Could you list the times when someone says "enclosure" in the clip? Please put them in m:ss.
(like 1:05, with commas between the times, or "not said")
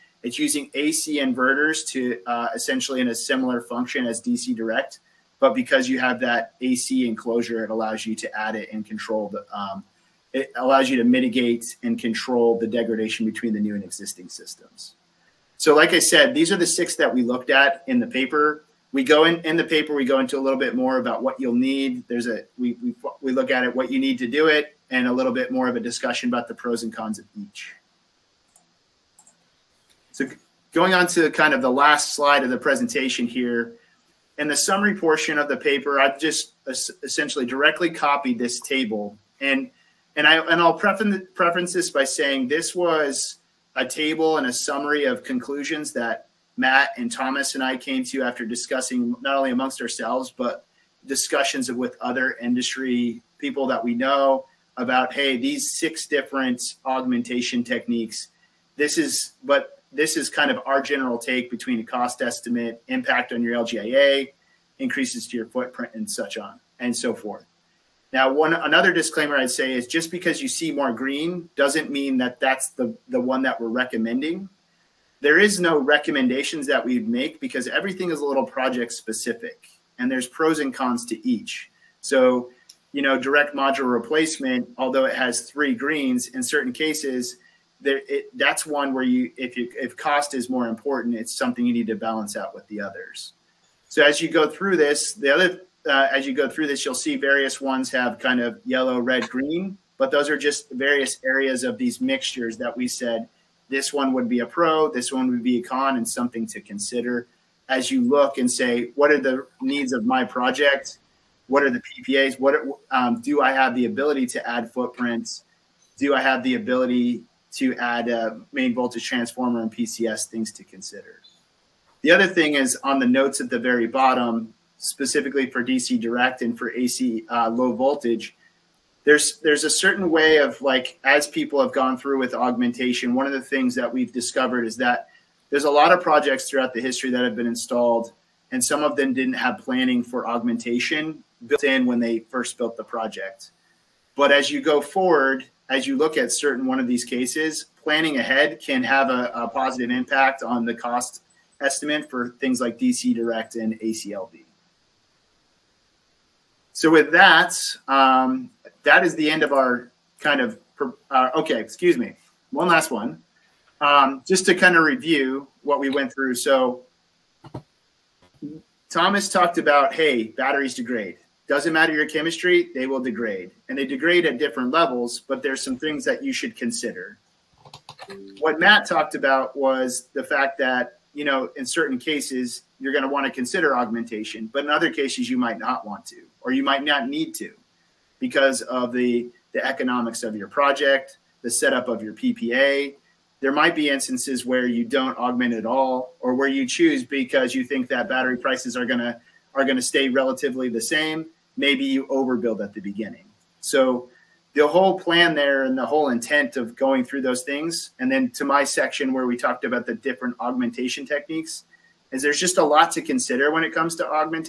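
0:07.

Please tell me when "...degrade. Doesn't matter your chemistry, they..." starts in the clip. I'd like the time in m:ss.
2:50.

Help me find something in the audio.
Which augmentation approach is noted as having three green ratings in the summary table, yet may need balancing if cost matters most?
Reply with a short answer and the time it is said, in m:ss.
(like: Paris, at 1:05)
Direct module replacement, at 1:23.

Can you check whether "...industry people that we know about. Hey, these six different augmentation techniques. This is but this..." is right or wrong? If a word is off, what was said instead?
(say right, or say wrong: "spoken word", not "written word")
right.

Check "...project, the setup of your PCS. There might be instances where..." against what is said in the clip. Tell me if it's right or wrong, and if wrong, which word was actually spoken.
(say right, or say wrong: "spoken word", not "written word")
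wrong: "PPA", not "PCS".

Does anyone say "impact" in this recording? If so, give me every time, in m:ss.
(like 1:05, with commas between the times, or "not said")
1:02, 2:29.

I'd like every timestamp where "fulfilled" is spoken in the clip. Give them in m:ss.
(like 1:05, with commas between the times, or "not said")
not said.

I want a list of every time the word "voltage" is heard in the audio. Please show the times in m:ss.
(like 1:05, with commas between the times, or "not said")
1:58, 2:07.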